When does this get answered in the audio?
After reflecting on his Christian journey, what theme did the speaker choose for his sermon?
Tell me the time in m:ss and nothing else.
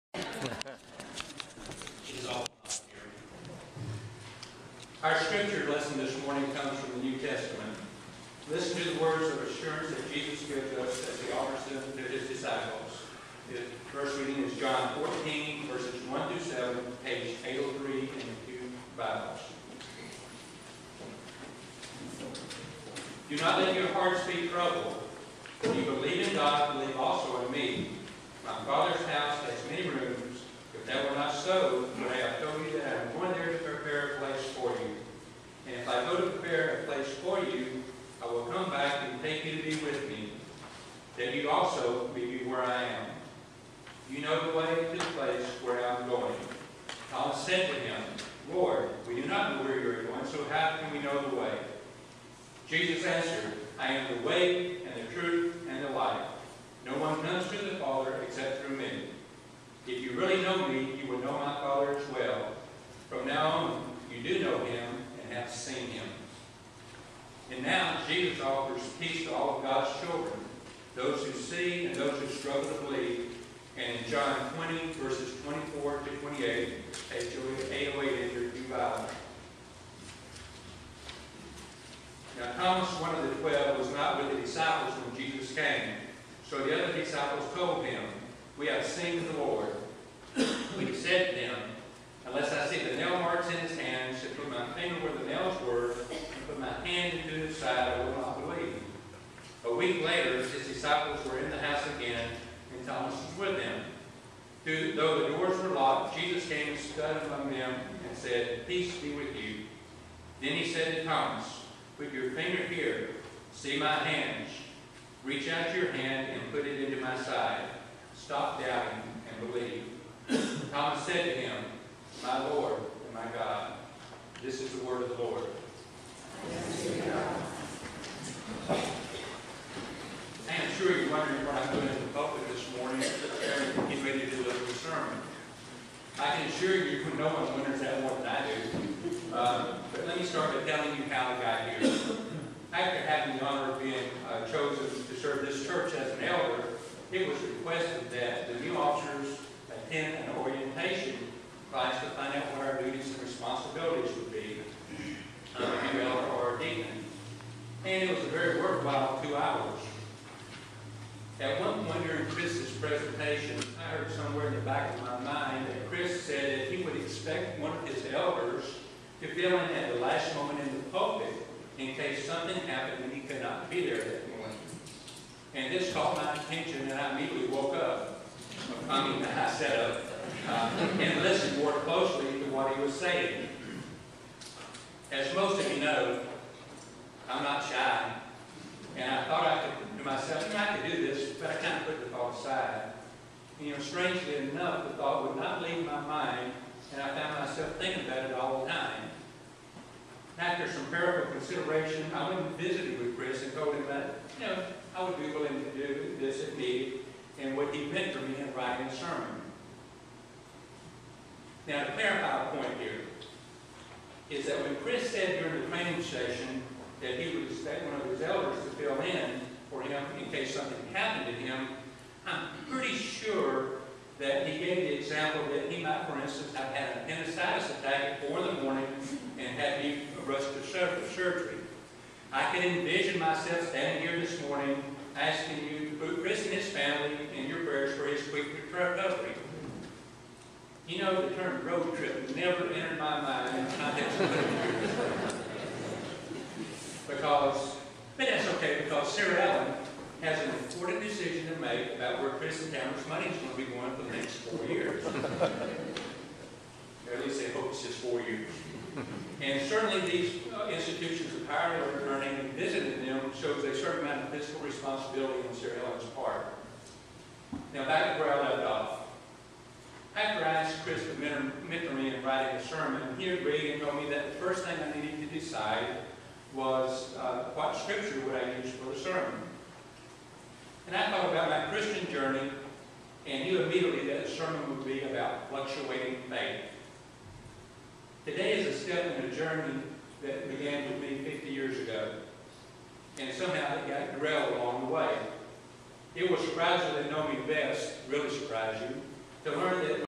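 4:45.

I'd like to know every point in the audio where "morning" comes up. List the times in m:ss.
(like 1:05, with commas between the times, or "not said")
0:06, 2:54, 3:54.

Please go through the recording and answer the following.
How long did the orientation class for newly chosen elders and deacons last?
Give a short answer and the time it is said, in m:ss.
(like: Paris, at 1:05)
two hours, at 2:39.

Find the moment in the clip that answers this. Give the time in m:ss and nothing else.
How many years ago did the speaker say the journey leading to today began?
4:51.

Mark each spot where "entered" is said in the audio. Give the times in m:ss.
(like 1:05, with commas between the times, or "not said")
1:18, 4:02.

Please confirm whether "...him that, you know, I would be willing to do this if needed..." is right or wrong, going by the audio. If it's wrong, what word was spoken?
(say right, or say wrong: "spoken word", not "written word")
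right.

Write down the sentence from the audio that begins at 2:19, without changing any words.
Uh, but let me start by telling you how I got here.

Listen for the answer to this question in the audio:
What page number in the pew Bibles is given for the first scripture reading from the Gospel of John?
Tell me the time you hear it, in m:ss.
0:17.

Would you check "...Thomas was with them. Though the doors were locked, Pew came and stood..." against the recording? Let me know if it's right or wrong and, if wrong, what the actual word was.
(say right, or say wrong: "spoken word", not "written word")
wrong: "Jesus", not "Pew".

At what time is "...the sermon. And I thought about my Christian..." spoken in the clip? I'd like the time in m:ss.
4:38.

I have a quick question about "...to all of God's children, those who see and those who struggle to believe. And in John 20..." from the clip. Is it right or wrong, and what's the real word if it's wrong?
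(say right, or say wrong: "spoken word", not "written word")
right.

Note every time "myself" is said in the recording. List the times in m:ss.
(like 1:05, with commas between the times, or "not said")
3:10, 3:17, 3:53.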